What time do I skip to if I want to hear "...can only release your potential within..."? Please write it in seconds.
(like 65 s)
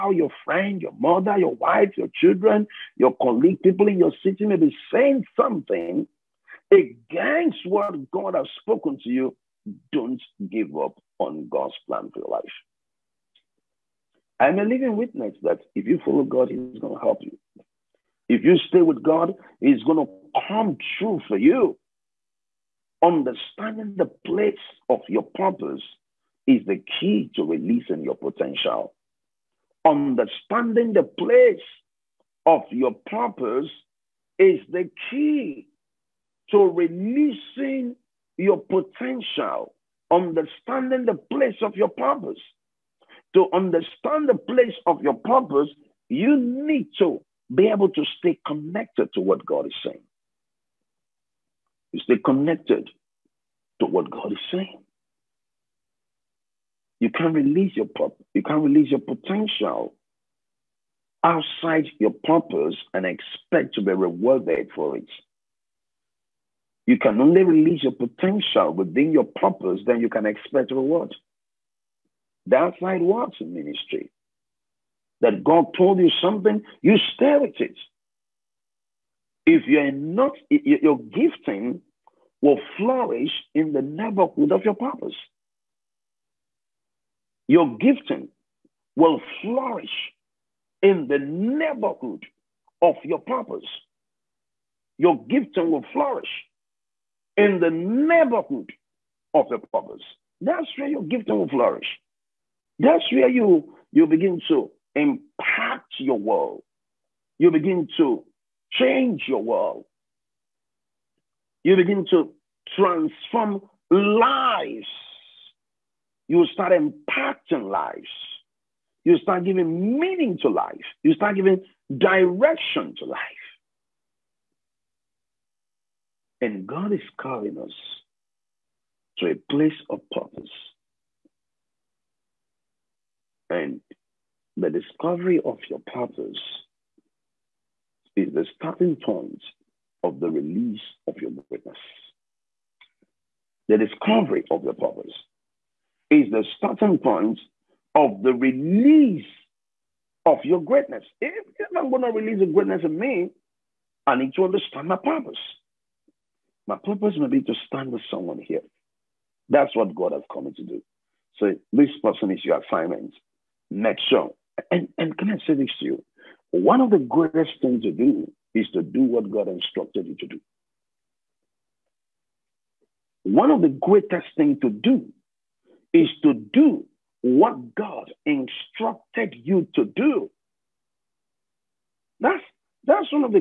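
66 s.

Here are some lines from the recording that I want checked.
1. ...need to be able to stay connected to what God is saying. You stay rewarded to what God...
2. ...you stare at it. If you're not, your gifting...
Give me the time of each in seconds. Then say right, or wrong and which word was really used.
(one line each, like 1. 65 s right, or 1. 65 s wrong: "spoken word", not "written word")
1. 46 s wrong: "connected", not "rewarded"
2. 76 s right.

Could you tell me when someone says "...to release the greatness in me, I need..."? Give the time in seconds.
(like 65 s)
152 s.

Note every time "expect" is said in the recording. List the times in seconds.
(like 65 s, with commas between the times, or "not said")
63 s, 70 s.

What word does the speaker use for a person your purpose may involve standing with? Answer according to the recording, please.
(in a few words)
assignment.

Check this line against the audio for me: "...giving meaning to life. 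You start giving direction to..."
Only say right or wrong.
right.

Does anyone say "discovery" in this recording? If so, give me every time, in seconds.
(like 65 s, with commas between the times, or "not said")
134 s, 143 s.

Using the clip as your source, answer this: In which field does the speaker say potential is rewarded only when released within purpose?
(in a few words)
ministry.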